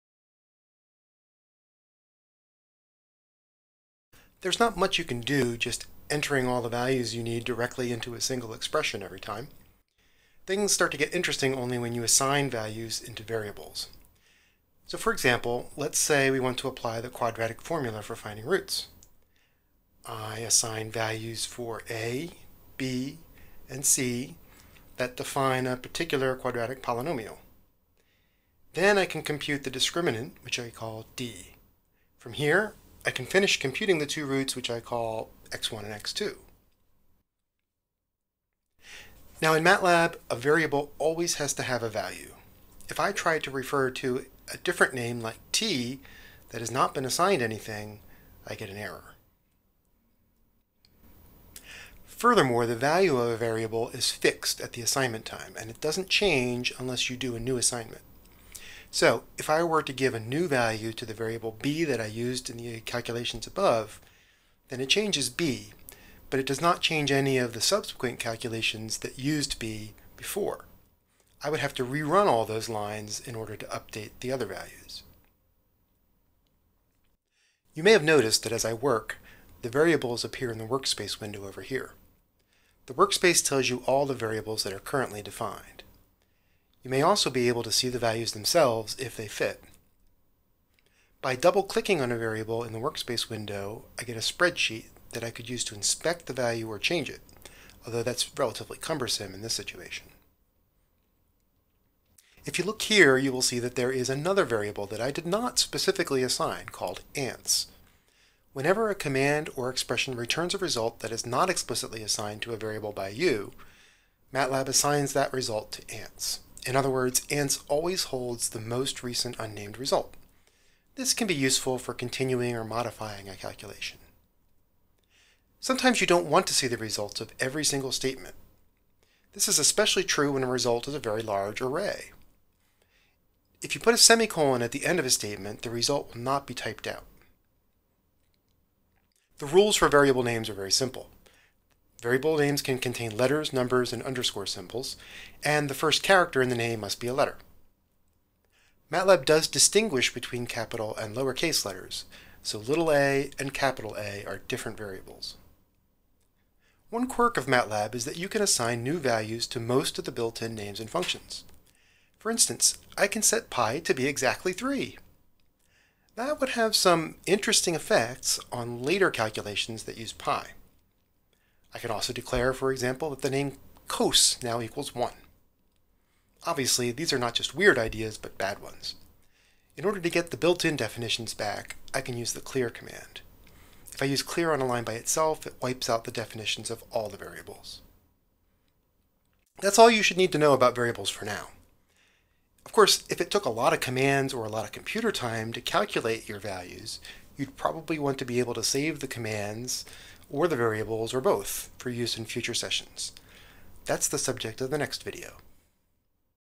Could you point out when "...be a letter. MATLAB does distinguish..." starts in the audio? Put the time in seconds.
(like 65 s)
146 s.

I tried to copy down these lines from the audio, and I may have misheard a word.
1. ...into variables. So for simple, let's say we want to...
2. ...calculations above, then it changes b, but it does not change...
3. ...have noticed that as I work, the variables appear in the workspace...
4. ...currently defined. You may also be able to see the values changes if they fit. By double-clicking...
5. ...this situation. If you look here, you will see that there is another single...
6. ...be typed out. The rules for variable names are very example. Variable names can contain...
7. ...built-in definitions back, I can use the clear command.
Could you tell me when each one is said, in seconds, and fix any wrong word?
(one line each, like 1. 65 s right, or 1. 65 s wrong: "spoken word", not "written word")
1. 13 s wrong: "example", not "simple"
2. 62 s right
3. 77 s right
4. 84 s wrong: "themselves", not "changes"
5. 99 s wrong: "variable", not "single"
6. 136 s wrong: "simple", not "example"
7. 180 s right.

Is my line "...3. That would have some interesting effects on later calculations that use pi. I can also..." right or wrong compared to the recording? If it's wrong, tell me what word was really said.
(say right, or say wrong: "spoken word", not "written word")
right.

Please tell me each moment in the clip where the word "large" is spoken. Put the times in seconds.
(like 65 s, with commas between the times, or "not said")
131 s.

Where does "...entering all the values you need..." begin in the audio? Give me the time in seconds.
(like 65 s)
6 s.